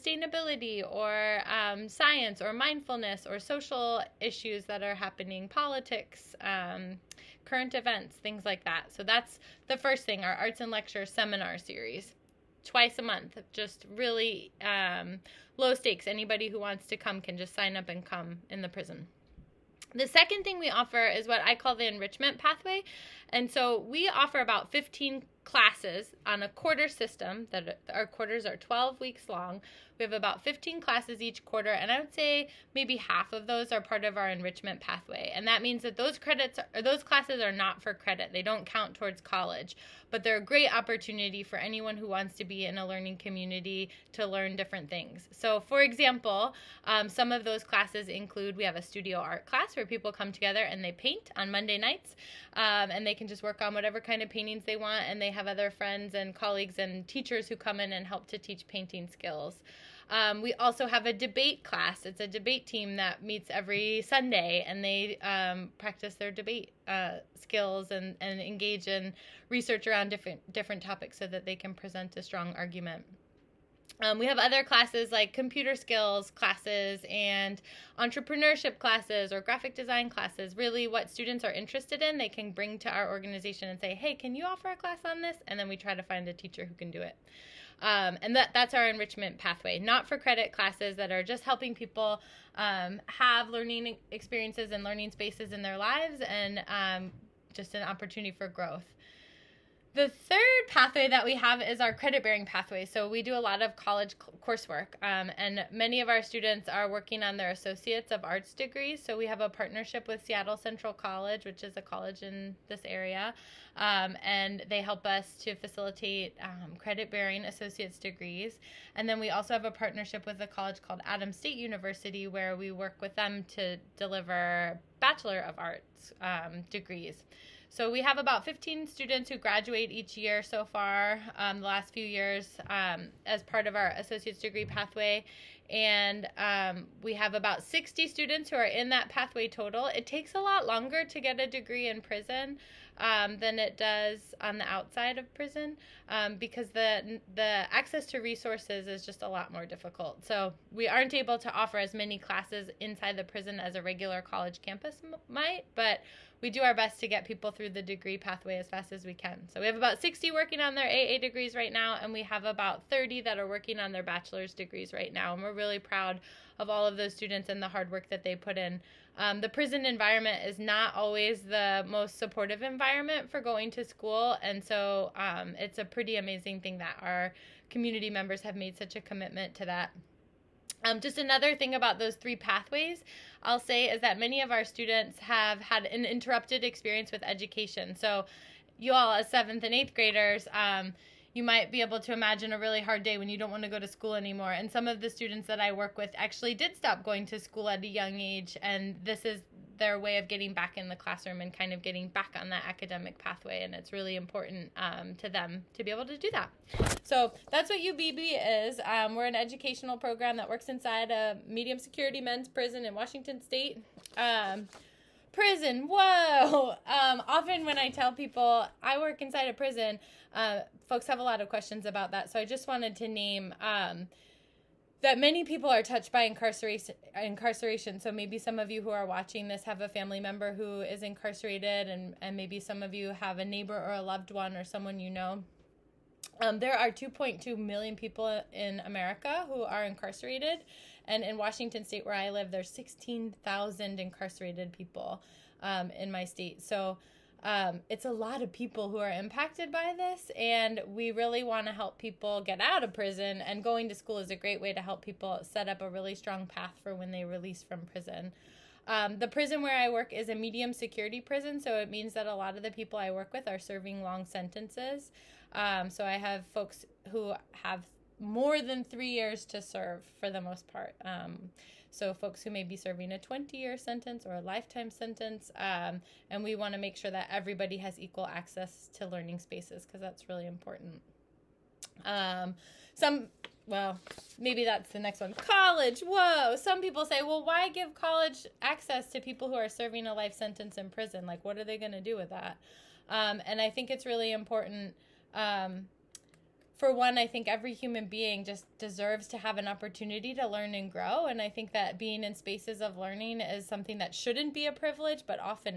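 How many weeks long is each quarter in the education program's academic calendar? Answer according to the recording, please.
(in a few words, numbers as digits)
12.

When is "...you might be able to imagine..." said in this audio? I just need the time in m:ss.
3:11.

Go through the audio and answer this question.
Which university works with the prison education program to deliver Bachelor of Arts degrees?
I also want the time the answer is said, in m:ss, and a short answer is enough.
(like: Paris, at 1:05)
Adams State University, at 2:01.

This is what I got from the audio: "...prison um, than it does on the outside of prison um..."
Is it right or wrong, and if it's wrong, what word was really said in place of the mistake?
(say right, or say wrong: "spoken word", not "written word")
right.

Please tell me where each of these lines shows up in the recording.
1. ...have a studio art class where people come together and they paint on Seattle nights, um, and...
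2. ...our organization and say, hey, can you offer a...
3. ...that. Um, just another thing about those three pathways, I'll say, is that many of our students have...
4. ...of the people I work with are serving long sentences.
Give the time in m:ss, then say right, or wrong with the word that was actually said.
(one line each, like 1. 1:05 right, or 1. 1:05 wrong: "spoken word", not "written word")
1. 0:48 wrong: "Monday", not "Seattle"
2. 1:22 right
3. 2:59 right
4. 4:22 right.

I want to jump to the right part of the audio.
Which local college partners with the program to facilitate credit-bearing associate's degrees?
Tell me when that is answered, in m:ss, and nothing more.
1:50.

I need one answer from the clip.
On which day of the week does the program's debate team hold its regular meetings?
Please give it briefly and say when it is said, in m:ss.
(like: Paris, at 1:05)
Sunday, at 1:03.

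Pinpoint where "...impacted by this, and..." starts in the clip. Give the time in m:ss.
4:09.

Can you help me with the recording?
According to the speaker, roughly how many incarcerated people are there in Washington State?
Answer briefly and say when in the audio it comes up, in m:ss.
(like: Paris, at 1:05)
16,000, at 4:02.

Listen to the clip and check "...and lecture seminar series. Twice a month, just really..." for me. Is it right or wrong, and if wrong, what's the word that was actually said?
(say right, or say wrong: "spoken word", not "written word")
right.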